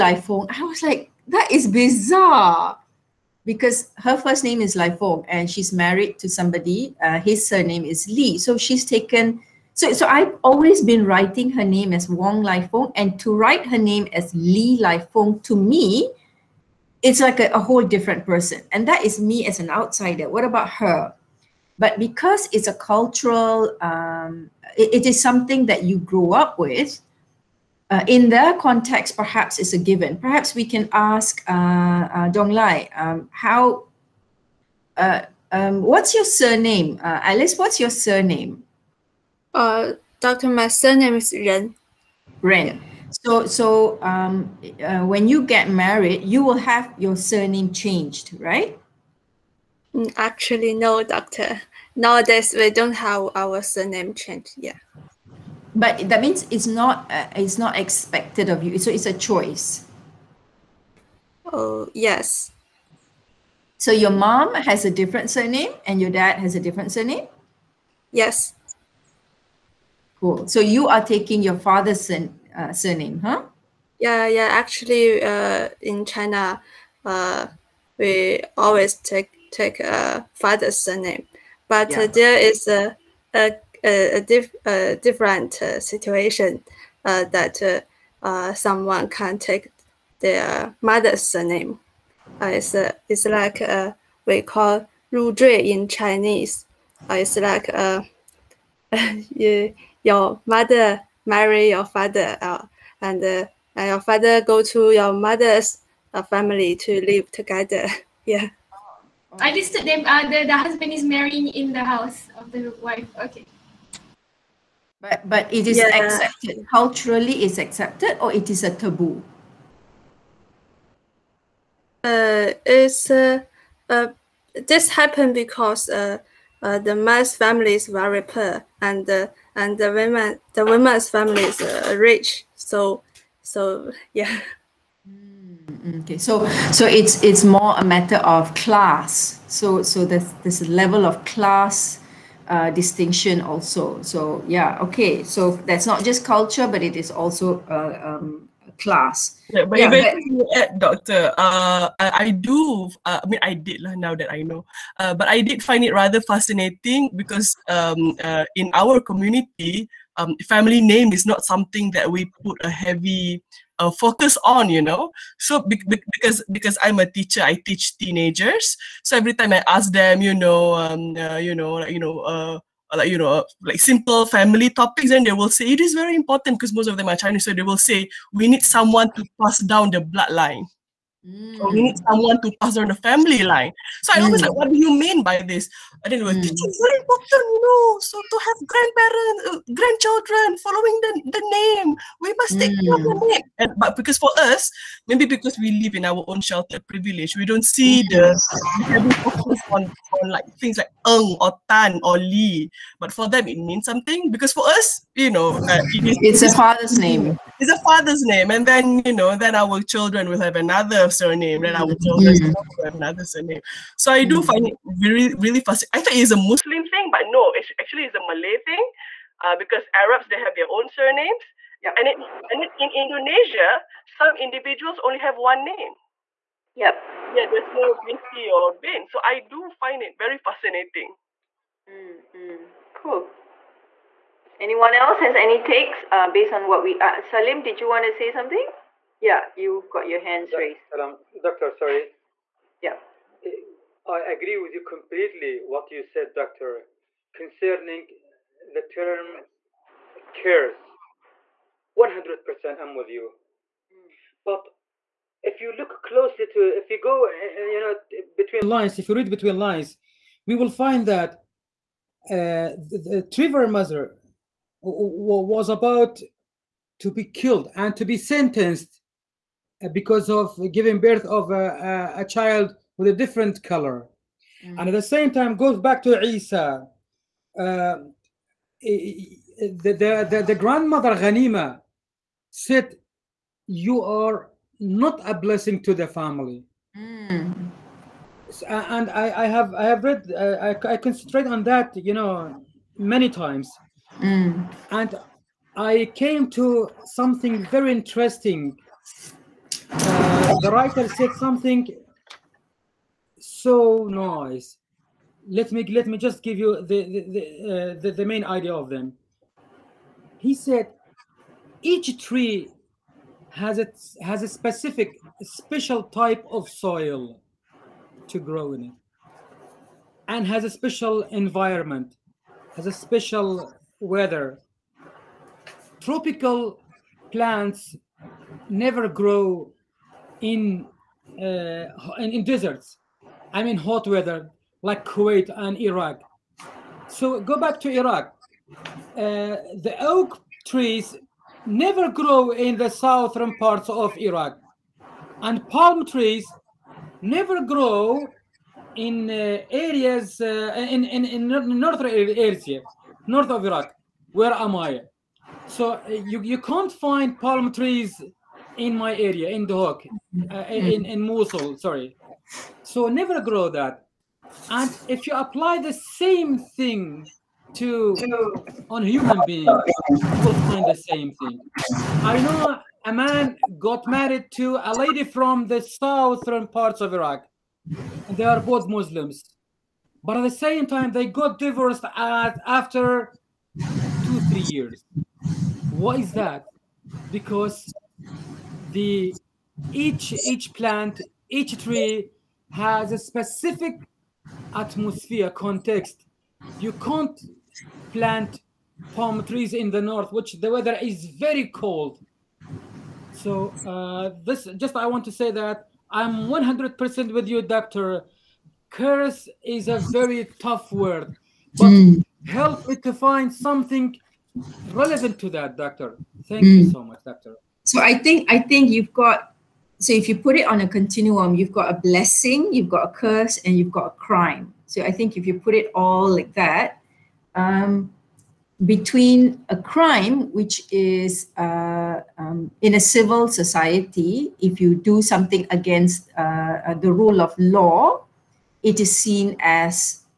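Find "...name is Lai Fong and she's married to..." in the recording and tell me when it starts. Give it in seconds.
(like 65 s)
4 s.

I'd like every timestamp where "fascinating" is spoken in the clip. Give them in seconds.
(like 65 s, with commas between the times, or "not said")
156 s, 215 s, 230 s.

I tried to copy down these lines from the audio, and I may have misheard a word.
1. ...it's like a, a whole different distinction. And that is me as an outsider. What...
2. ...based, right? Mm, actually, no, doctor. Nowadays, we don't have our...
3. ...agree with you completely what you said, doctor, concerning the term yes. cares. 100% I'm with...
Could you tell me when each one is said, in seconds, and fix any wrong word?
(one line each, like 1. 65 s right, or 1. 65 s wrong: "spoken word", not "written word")
1. 17 s wrong: "person", not "distinction"
2. 47 s wrong: "changed", not "based"
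3. 244 s right.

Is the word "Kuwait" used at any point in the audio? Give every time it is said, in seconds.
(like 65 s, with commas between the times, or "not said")
335 s.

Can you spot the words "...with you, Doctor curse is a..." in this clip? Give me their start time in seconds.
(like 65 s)
407 s.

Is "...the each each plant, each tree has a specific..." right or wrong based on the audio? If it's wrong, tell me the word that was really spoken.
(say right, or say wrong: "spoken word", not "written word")
right.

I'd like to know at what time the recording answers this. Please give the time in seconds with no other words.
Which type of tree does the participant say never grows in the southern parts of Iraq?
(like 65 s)
339 s.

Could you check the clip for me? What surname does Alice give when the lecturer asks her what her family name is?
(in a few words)
Ren.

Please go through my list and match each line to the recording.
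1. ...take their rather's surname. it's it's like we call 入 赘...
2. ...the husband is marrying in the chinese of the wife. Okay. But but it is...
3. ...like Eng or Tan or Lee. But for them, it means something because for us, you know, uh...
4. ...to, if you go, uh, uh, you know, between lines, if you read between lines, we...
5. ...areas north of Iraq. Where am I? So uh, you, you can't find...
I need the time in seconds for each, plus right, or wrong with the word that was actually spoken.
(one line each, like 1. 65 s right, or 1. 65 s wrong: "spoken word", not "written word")
1. 89 s wrong: "mother", not "rather"
2. 110 s wrong: "house", not "chinese"
3. 200 s right
4. 256 s right
5. 352 s right.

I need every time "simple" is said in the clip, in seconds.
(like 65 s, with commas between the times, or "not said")
173 s.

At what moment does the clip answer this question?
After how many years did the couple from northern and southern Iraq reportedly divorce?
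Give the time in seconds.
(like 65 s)
383 s.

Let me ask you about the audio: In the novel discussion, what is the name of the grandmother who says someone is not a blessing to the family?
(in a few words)
Ghanima.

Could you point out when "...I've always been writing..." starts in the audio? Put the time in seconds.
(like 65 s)
10 s.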